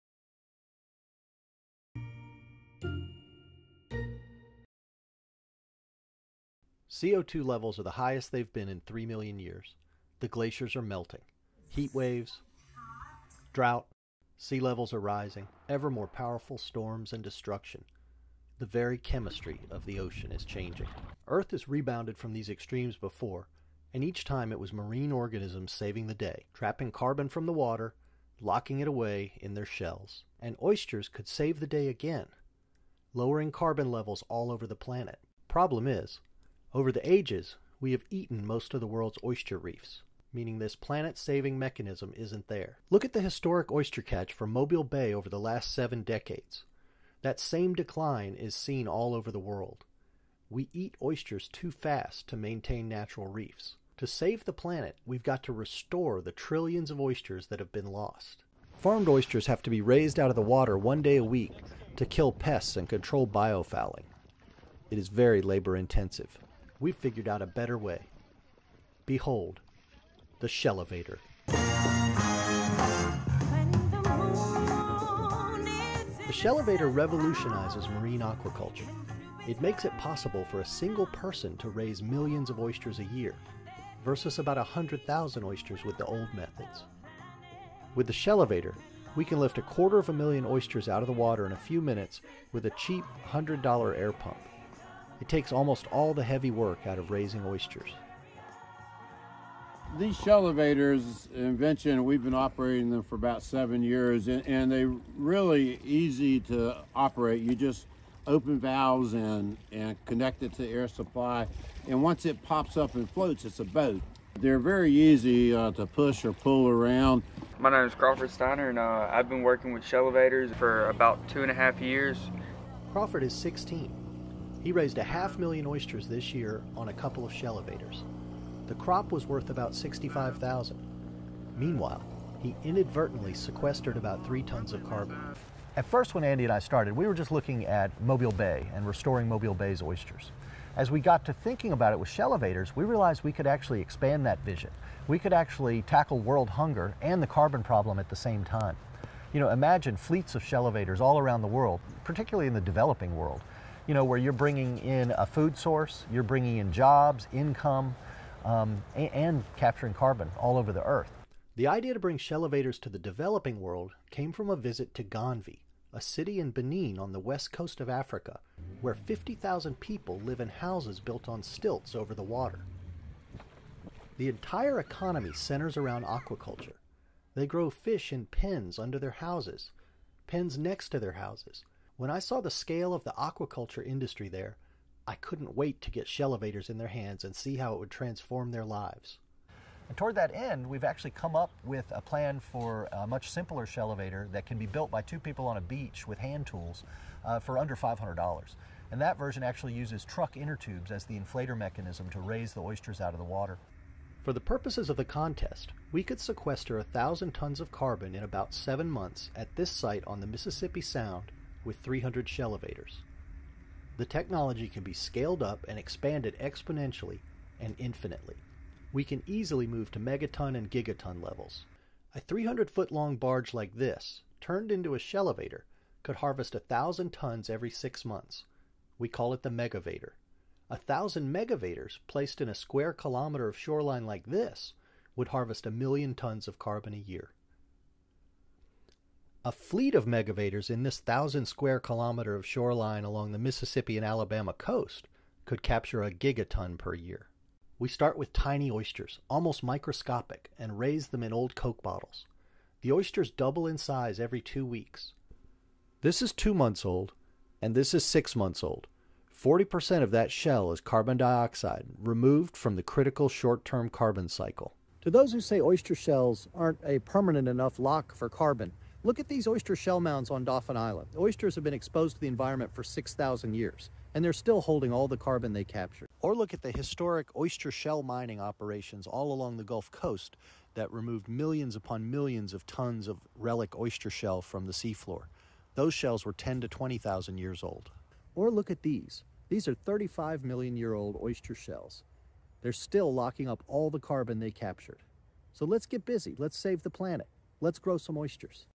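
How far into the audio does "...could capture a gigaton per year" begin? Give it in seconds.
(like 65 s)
245 s.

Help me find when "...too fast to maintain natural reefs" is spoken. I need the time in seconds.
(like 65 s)
51 s.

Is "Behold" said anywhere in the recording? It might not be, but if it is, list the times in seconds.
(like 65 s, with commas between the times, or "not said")
69 s.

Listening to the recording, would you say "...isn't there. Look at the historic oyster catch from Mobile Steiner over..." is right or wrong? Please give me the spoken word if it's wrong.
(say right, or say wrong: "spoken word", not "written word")
wrong: "Bay", not "Steiner".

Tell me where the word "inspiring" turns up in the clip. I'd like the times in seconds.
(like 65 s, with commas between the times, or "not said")
not said.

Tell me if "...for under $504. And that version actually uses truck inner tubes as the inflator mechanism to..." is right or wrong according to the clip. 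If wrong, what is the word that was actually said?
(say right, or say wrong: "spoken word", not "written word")
wrong: "500", not "504".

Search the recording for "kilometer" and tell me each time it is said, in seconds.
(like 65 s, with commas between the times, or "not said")
232 s, 241 s.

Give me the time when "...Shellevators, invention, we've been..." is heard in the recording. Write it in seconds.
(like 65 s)
100 s.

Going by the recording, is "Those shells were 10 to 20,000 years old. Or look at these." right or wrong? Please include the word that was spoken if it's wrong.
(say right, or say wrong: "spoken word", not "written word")
right.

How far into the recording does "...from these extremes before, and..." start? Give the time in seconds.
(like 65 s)
22 s.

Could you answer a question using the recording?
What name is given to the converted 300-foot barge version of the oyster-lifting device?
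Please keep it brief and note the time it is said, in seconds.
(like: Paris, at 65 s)
megavator, at 229 s.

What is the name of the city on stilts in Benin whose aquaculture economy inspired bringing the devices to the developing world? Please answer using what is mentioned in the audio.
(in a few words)
Ganvie.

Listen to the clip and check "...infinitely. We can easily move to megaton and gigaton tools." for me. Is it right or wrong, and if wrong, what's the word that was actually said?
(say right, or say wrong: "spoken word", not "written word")
wrong: "levels", not "tools".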